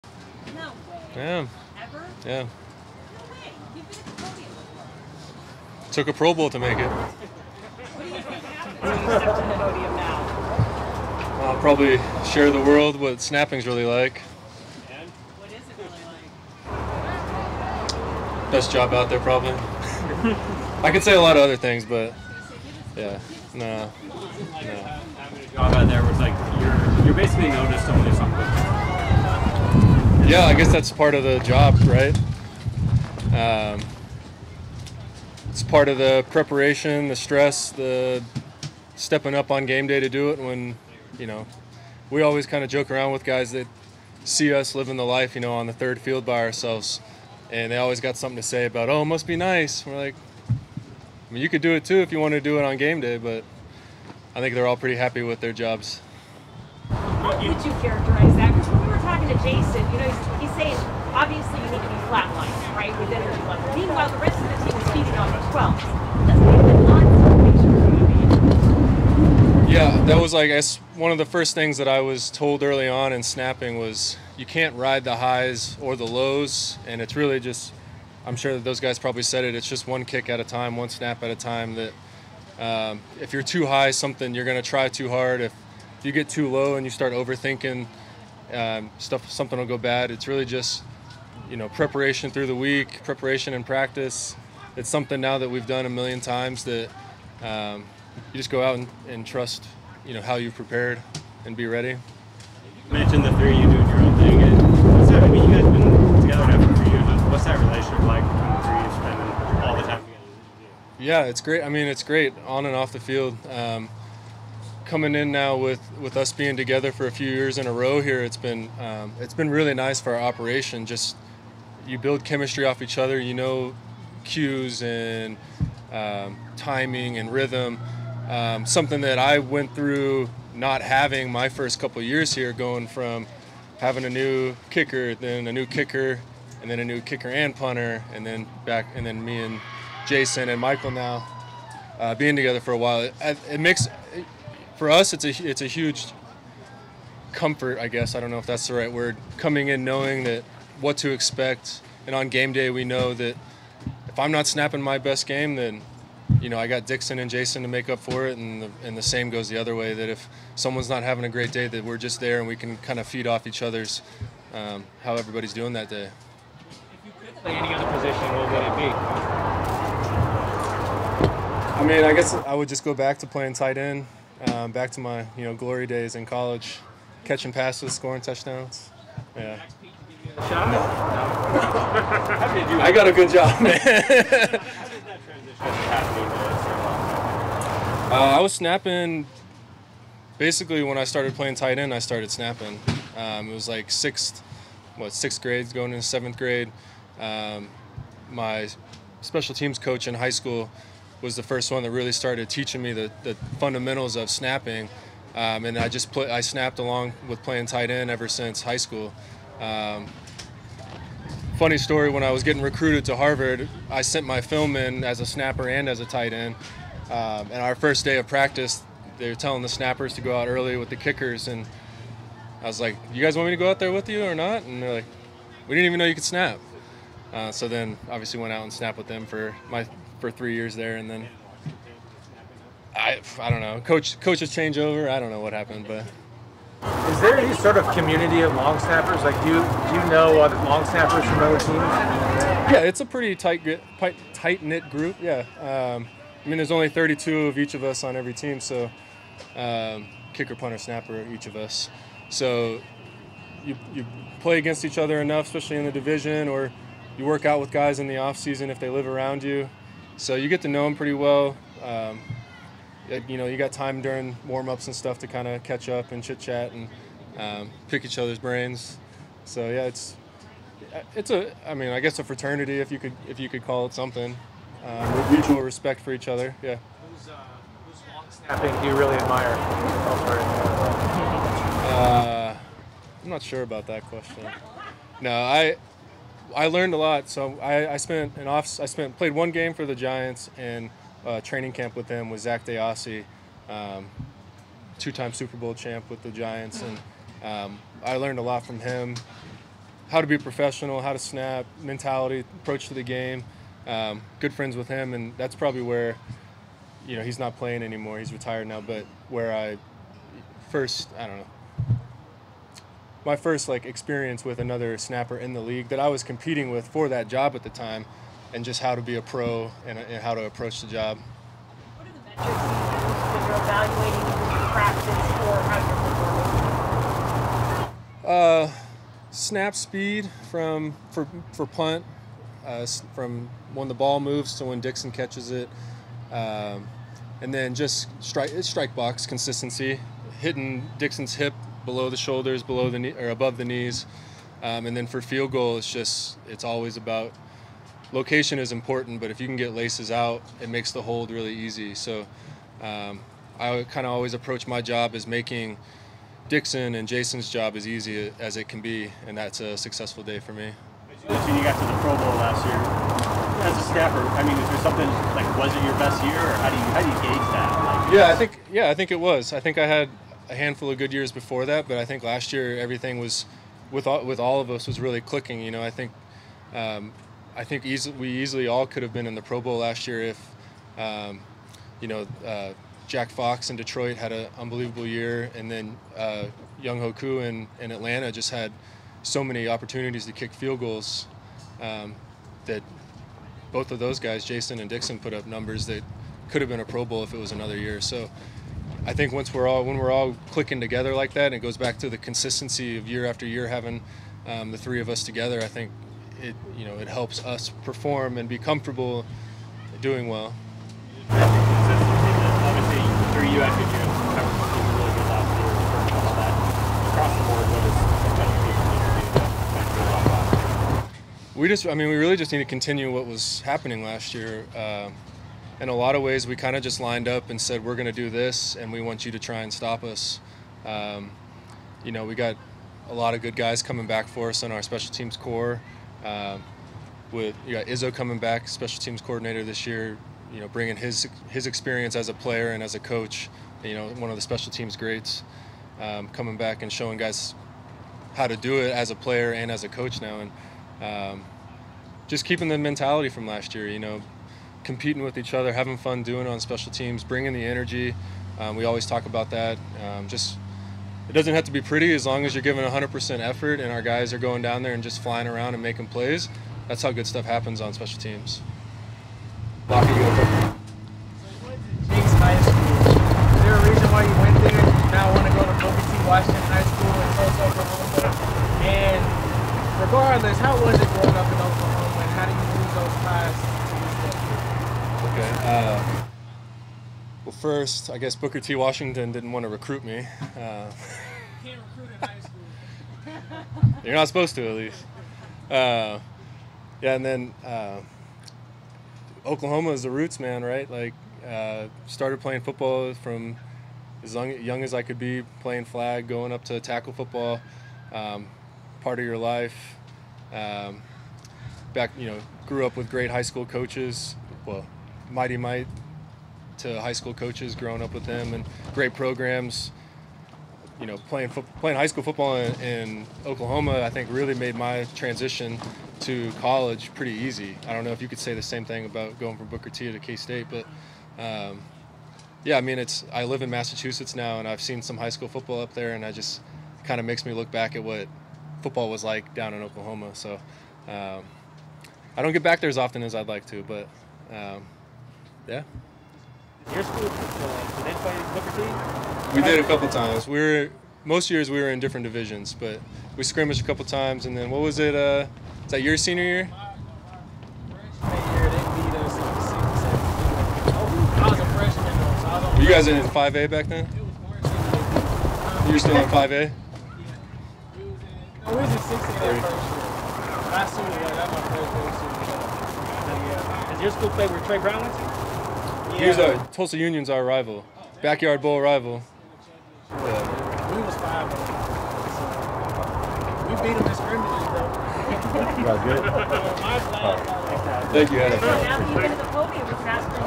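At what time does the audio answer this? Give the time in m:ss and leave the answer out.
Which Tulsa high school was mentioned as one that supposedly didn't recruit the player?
7:55.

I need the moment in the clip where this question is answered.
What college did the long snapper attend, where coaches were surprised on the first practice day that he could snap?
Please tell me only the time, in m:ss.
3:33.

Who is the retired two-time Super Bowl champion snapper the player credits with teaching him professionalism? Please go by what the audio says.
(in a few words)
Zak DeOssie.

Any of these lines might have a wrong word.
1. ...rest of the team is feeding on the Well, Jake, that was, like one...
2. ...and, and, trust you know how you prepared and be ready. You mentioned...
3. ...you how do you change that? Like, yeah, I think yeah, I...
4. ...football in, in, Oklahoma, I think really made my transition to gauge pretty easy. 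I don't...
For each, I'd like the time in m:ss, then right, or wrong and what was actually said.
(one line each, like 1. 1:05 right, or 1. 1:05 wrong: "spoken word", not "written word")
1. 1:04 wrong: "Yeah", not "Jake"
2. 1:38 right
3. 6:06 wrong: "gauge", not "change"
4. 8:42 wrong: "college", not "gauge".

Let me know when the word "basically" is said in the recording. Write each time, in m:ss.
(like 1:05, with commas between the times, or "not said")
0:27, 3:10.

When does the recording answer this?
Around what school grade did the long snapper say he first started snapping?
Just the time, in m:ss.
3:15.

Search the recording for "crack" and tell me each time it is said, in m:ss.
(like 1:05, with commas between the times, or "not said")
not said.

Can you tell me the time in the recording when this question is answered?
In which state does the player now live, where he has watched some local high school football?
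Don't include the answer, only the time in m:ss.
8:53.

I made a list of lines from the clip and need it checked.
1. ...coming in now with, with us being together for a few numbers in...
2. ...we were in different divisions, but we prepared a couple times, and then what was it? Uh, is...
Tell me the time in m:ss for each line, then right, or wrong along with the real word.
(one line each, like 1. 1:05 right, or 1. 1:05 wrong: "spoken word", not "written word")
1. 1:54 wrong: "years", not "numbers"
2. 9:11 wrong: "scrimmaged", not "prepared".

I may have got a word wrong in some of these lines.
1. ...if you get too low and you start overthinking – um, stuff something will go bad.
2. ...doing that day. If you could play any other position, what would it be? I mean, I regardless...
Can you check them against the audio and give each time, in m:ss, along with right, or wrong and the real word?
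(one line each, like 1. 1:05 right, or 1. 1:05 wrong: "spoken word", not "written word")
1. 1:25 right
2. 2:45 wrong: "guess", not "regardless".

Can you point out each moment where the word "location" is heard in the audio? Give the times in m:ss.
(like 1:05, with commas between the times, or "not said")
5:48.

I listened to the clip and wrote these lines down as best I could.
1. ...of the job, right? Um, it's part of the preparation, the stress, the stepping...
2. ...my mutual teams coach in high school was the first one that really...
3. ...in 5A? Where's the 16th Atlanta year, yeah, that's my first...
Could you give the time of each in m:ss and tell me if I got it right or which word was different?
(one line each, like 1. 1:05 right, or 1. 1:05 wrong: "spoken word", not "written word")
1. 0:31 right
2. 3:18 wrong: "special", not "mutual"
3. 9:26 wrong: "Last", not "Atlanta".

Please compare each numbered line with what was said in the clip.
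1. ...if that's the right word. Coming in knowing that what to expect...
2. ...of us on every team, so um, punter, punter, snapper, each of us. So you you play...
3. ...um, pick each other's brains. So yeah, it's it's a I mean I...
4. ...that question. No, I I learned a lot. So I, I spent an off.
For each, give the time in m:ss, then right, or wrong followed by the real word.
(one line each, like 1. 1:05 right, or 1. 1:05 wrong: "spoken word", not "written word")
1. 2:28 right
2. 4:07 wrong: "kicker", not "punter"
3. 4:27 right
4. 4:43 right.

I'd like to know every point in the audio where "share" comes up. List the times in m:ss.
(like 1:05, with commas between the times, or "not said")
0:12.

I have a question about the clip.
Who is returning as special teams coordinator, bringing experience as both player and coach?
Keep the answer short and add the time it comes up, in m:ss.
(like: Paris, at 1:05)
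Izzo, at 7:17.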